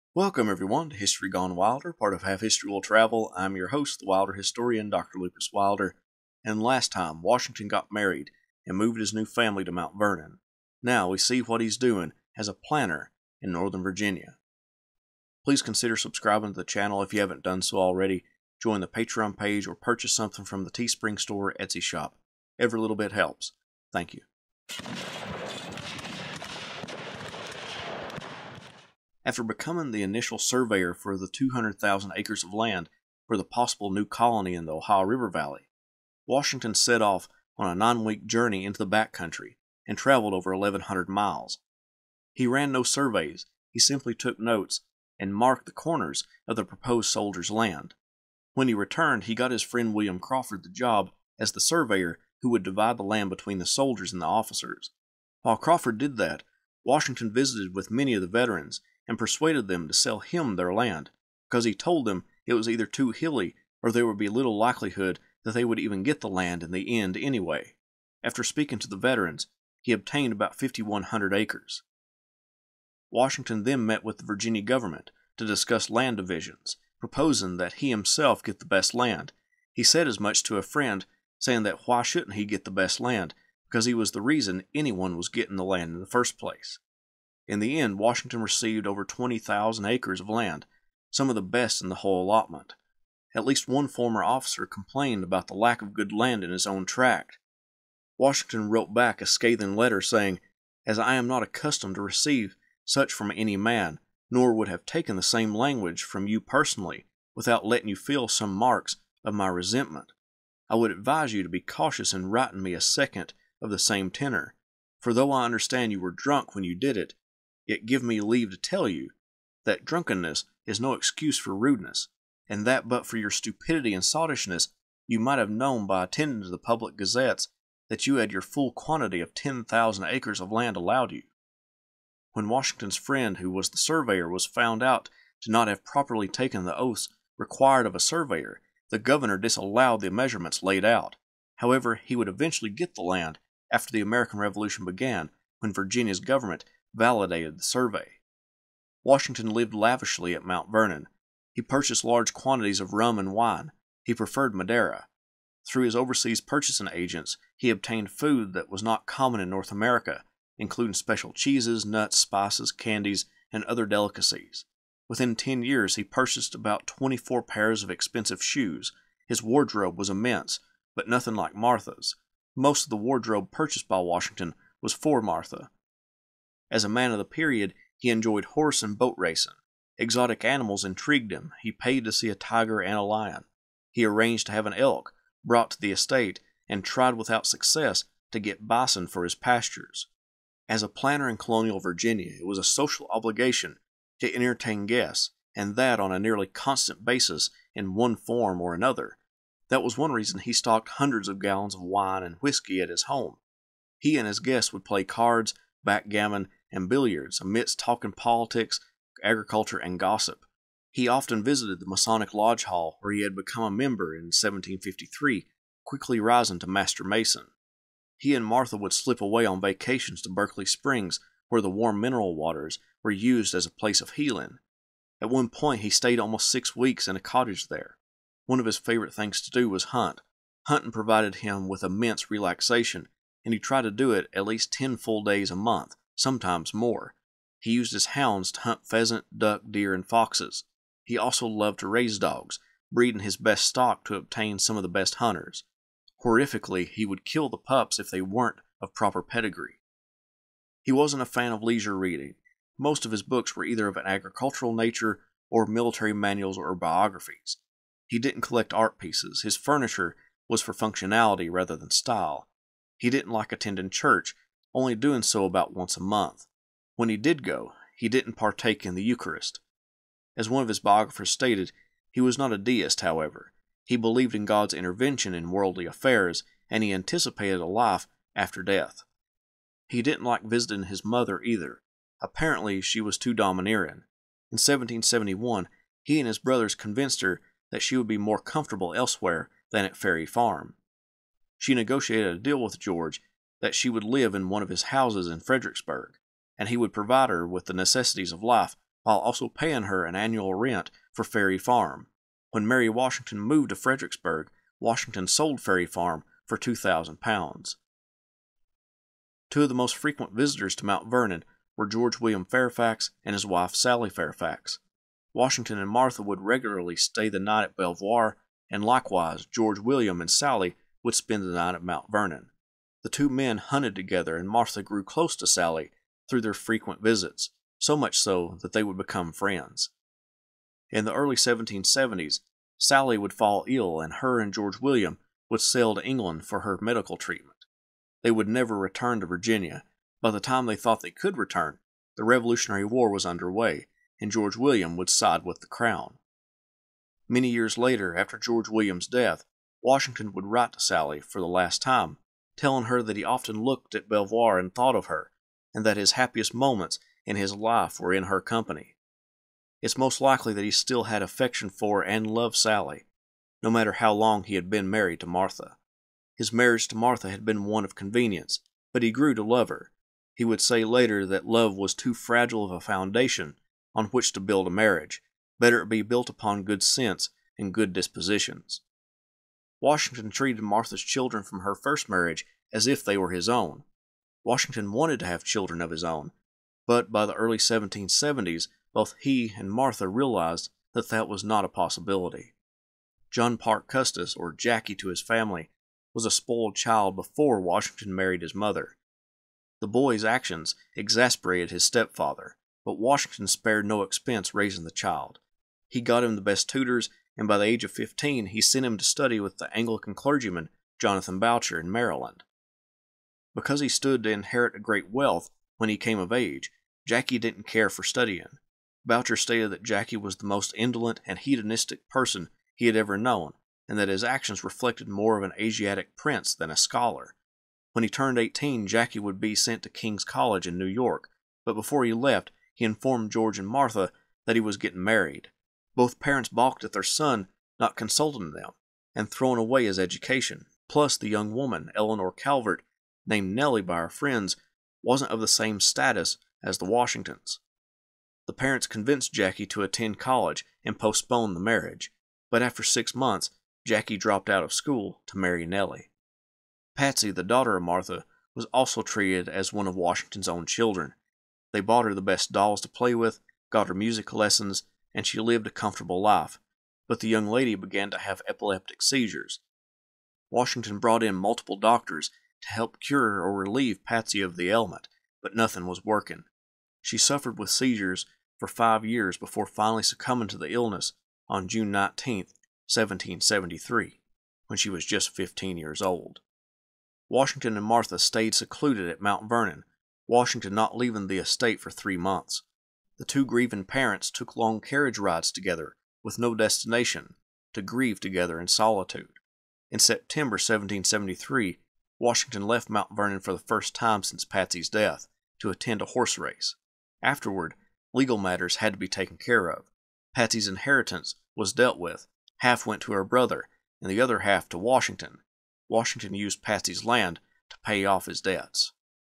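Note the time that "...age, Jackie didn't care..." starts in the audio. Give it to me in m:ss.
6:56.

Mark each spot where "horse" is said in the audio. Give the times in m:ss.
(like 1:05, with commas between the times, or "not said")
2:58, 8:26.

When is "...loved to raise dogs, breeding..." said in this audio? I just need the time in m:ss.
4:01.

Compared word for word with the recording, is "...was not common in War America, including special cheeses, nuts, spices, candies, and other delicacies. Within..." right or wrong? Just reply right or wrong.
wrong.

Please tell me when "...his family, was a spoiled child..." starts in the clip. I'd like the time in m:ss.
6:35.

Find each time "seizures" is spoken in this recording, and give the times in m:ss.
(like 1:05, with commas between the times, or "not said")
7:49, 7:57.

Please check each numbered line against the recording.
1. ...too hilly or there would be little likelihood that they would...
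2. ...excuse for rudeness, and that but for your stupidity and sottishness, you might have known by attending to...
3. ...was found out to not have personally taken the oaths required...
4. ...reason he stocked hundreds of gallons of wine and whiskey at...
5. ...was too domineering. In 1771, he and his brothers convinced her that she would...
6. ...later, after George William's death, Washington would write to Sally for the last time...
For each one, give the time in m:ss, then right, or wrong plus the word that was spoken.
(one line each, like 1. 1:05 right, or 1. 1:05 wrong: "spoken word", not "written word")
1. 1:02 right
2. 2:00 right
3. 2:14 wrong: "properly", not "personally"
4. 3:20 right
5. 4:43 right
6. 5:47 right.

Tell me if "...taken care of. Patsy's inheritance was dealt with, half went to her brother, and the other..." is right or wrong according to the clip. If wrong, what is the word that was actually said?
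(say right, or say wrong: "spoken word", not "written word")
right.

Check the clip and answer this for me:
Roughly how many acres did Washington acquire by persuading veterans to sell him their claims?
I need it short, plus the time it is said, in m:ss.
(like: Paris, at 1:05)
5,100, at 1:10.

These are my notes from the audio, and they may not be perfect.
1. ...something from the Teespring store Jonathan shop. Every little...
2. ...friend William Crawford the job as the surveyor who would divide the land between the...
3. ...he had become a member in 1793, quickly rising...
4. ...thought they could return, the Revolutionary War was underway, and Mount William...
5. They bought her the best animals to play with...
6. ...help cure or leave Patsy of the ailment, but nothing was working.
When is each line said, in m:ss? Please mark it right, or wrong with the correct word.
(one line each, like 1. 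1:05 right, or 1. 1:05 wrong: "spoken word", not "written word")
1. 0:20 wrong: "Etsy", not "Jonathan"
2. 0:49 right
3. 3:33 wrong: "1753", not "1793"
4. 5:40 wrong: "George", not "Mount"
5. 7:41 wrong: "dolls", not "animals"
6. 7:52 wrong: "relieve", not "leave".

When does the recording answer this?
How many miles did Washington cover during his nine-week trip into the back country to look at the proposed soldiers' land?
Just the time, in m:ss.
0:40.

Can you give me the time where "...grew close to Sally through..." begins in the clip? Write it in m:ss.
5:24.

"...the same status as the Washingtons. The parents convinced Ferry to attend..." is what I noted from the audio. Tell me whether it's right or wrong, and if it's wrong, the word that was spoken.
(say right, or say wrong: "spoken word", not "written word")
wrong: "Jackie", not "Ferry".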